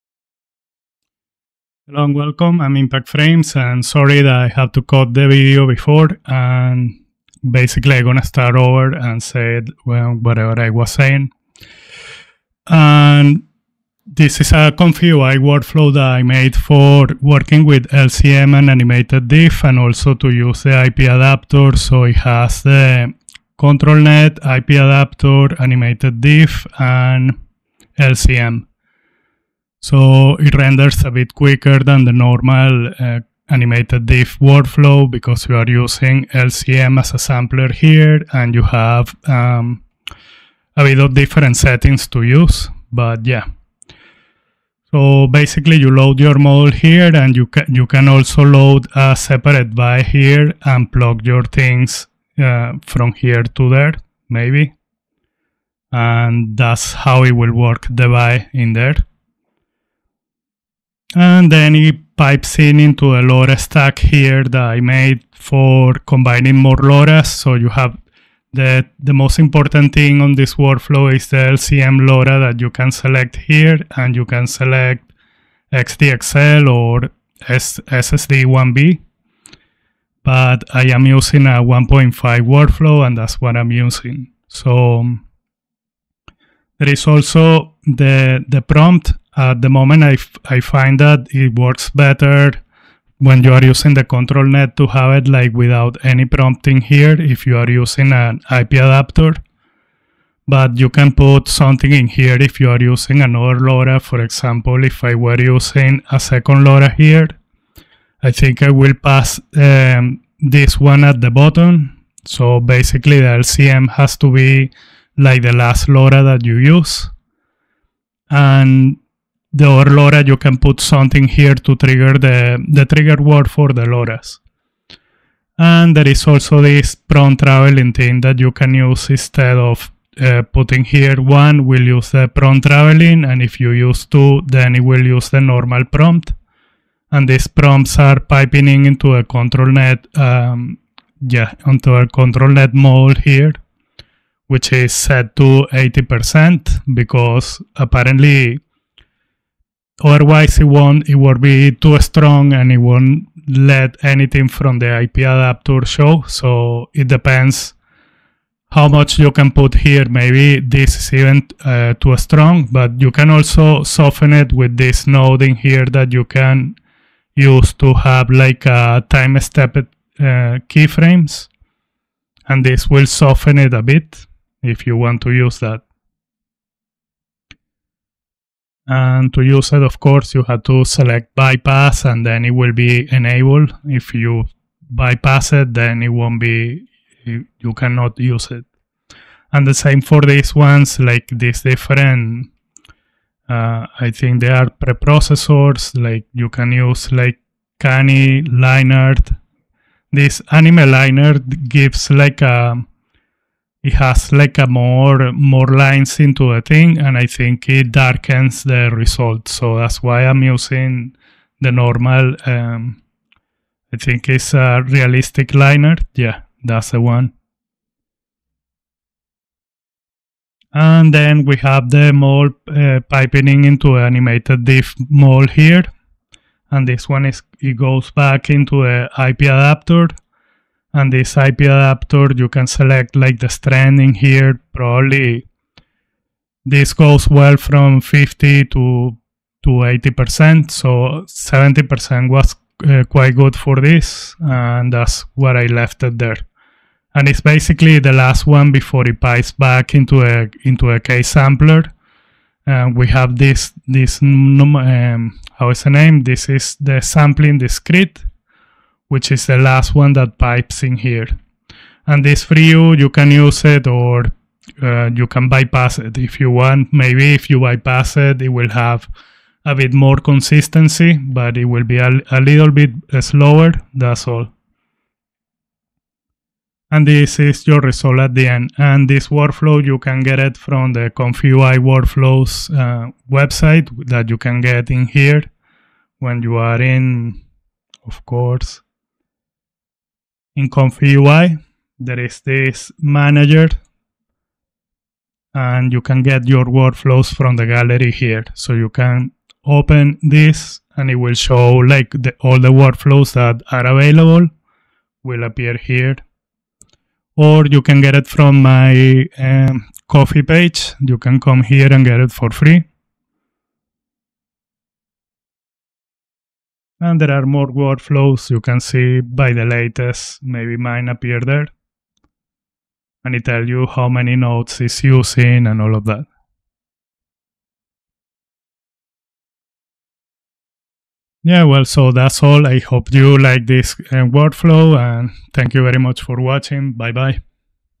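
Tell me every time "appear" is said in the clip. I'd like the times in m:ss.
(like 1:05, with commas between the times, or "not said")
5:05, 5:21.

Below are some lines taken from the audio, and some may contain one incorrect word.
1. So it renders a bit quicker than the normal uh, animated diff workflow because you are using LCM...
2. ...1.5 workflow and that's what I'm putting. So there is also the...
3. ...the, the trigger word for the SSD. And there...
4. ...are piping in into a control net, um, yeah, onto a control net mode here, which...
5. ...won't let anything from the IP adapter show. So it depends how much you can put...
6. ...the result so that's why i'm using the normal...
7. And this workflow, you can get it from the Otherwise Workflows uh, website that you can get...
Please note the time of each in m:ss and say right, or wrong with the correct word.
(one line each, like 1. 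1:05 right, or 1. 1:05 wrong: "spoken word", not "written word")
1. 0:29 right
2. 1:21 wrong: "using", not "putting"
3. 2:02 wrong: "Loras", not "SSD"
4. 2:17 right
5. 2:32 right
6. 3:28 right
7. 4:38 wrong: "ComfyUI", not "Otherwise".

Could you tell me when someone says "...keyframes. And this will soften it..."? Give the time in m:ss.
2:50.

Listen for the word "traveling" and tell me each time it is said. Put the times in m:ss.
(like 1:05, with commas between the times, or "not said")
2:07, 2:12.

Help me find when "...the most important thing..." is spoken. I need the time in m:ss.
1:08.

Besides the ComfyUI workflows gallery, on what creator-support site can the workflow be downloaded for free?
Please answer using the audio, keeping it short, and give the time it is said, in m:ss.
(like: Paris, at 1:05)
Ko-fi, at 5:10.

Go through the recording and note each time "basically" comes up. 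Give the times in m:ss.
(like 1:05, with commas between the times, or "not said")
0:07, 0:45, 1:52, 4:07.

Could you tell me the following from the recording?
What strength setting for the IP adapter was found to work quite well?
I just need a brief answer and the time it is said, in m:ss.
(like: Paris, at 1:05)
70%, at 4:01.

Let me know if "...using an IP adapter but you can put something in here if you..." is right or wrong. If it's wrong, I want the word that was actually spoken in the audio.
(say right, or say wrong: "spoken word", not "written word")
right.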